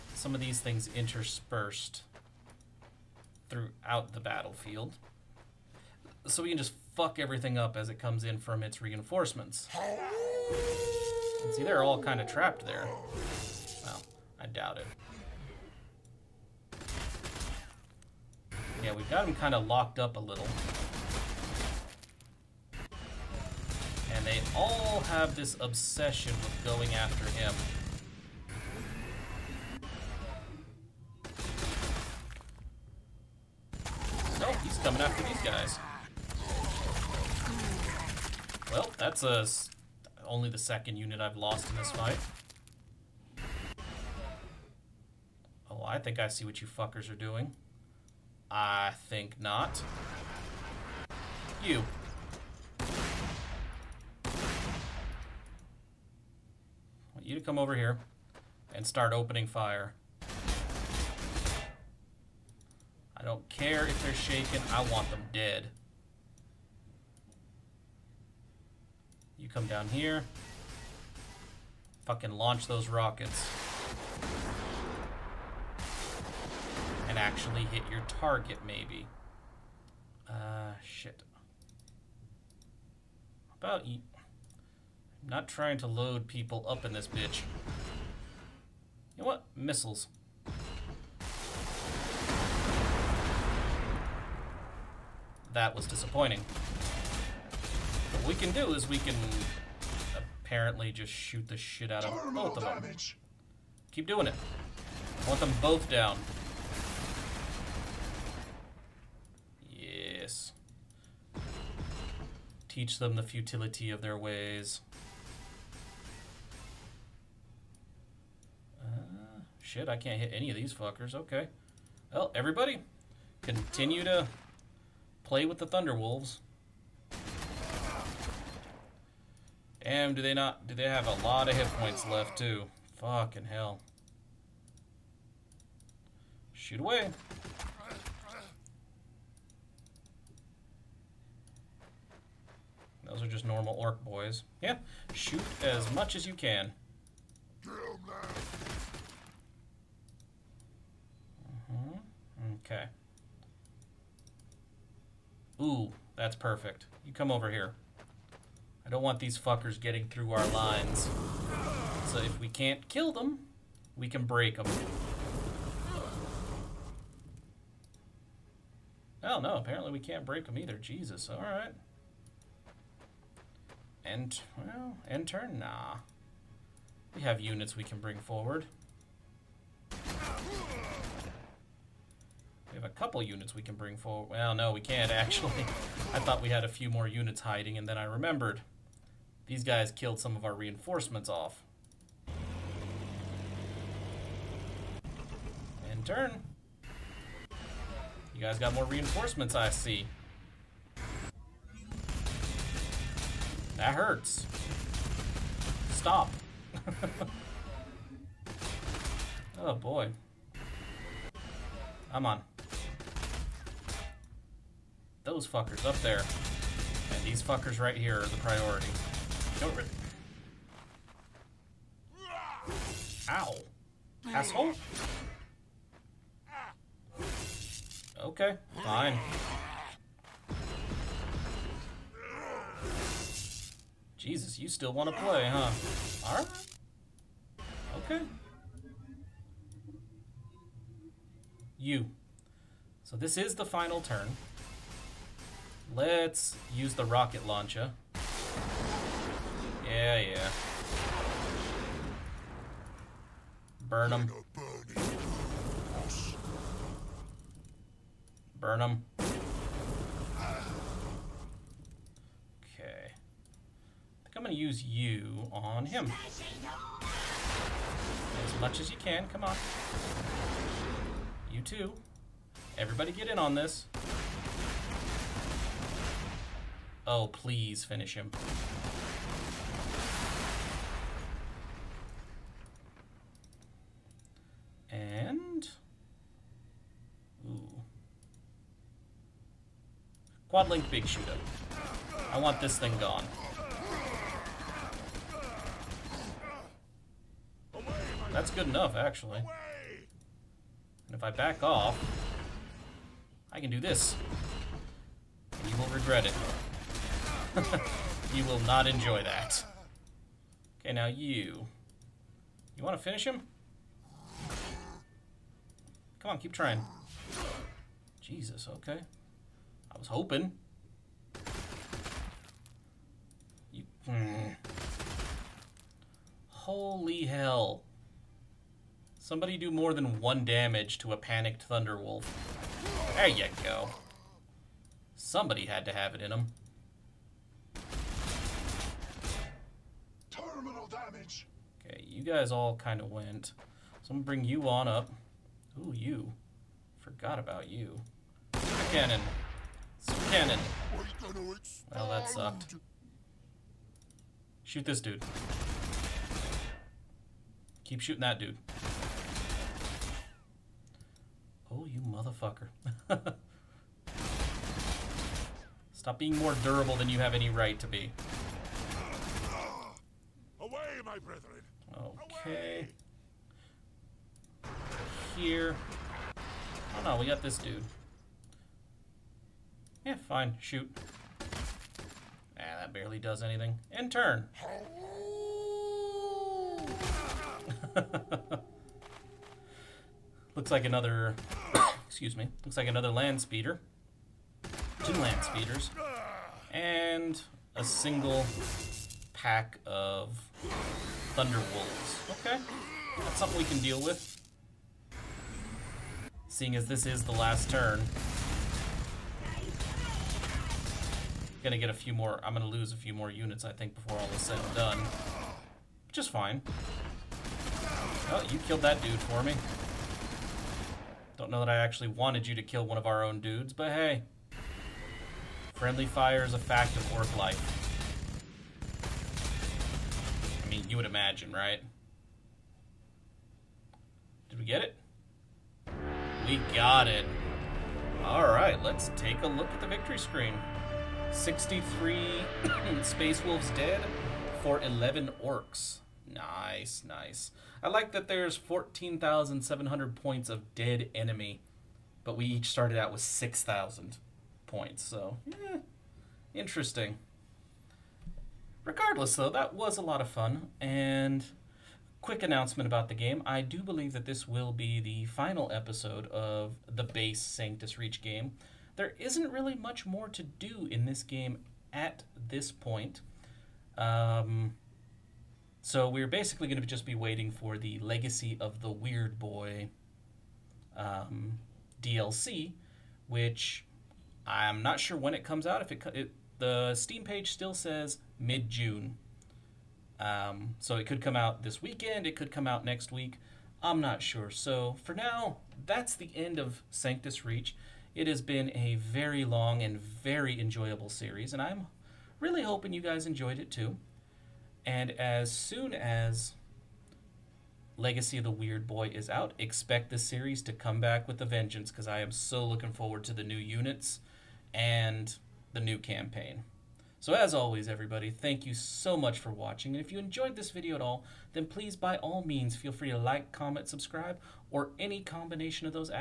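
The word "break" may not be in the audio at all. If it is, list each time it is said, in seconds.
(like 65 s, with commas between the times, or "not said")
164 s, 170 s.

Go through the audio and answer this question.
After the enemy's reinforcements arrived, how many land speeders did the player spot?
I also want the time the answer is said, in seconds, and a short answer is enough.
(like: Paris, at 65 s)
2, at 395 s.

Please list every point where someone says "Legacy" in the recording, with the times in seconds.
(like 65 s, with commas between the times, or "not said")
478 s, 507 s.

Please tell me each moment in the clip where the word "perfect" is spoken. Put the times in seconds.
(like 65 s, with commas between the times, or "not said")
156 s.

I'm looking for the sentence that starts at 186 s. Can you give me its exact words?
I thought we had a few more units hiding, and then I remembered.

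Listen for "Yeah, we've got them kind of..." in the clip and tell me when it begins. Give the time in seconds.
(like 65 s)
18 s.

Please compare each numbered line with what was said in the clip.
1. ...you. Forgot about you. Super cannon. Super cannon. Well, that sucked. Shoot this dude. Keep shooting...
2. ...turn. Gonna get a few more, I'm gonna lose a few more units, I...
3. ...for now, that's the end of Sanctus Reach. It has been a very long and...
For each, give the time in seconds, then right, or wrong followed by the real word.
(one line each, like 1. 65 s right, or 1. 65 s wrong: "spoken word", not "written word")
1. 345 s right
2. 407 s right
3. 495 s right.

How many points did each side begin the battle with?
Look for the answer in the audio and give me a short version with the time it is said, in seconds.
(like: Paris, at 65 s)
6,000, at 453 s.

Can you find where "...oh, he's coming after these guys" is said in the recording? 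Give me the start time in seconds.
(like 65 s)
34 s.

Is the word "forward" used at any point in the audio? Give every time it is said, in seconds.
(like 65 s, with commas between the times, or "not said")
178 s, 183 s, 512 s.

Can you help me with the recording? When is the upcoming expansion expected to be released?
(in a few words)
mid June.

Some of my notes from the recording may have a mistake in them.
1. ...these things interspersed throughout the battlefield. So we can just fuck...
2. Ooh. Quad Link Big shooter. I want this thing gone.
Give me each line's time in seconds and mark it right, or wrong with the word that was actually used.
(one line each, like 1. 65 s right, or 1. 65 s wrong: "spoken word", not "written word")
1. 0 s right
2. 287 s right.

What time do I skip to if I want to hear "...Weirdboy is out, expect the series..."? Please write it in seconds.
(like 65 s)
508 s.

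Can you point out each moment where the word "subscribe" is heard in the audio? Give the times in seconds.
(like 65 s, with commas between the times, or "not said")
523 s.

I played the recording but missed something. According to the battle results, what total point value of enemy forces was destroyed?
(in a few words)
14,700.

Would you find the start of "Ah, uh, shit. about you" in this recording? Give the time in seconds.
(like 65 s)
80 s.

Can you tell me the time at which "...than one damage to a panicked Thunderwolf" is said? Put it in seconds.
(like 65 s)
329 s.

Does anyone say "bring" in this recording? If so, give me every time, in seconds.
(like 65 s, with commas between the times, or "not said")
177 s, 183 s, 344 s.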